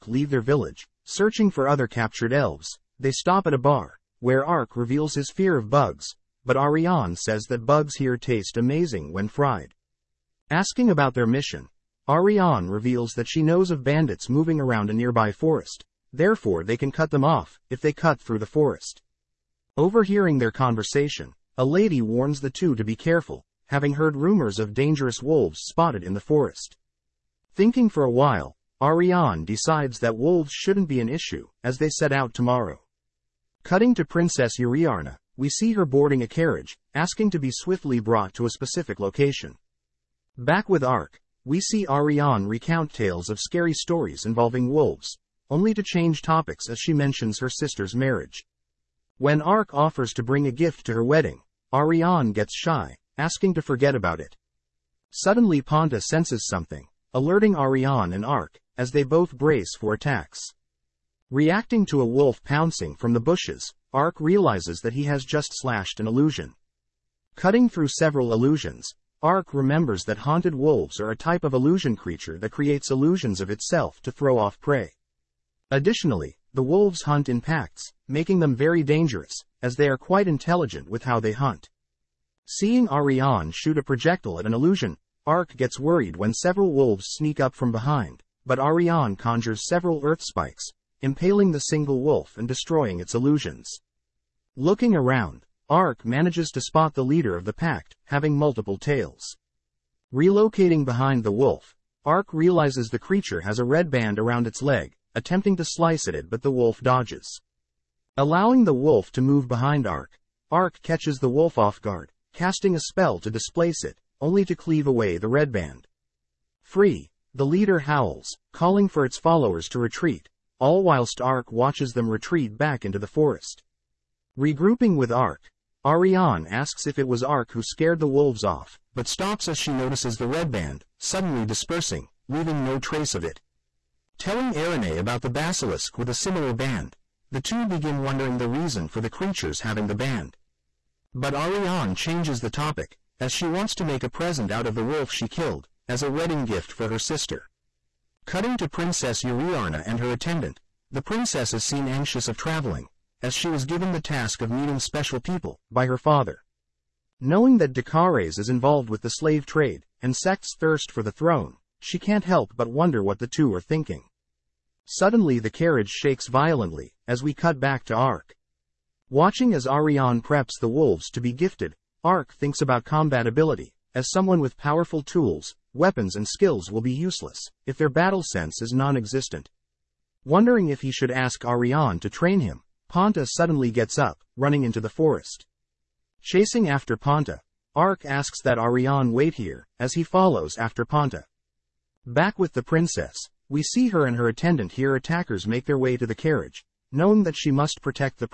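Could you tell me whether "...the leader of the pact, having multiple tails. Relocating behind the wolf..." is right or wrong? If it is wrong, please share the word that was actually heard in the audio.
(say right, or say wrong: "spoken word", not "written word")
right.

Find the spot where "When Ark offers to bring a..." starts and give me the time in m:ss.
0:49.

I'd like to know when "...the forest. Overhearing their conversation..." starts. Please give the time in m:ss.
0:18.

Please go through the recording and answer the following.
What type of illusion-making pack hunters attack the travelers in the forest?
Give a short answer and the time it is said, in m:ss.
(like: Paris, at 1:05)
Haunted wolves, at 1:10.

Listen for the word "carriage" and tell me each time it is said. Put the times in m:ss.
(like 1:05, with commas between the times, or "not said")
0:36, 2:45, 3:16.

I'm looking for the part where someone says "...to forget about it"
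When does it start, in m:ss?
0:53.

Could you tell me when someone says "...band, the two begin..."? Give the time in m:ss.
2:16.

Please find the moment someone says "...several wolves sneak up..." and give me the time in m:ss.
1:26.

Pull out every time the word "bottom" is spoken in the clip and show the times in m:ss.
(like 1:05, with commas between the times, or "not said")
not said.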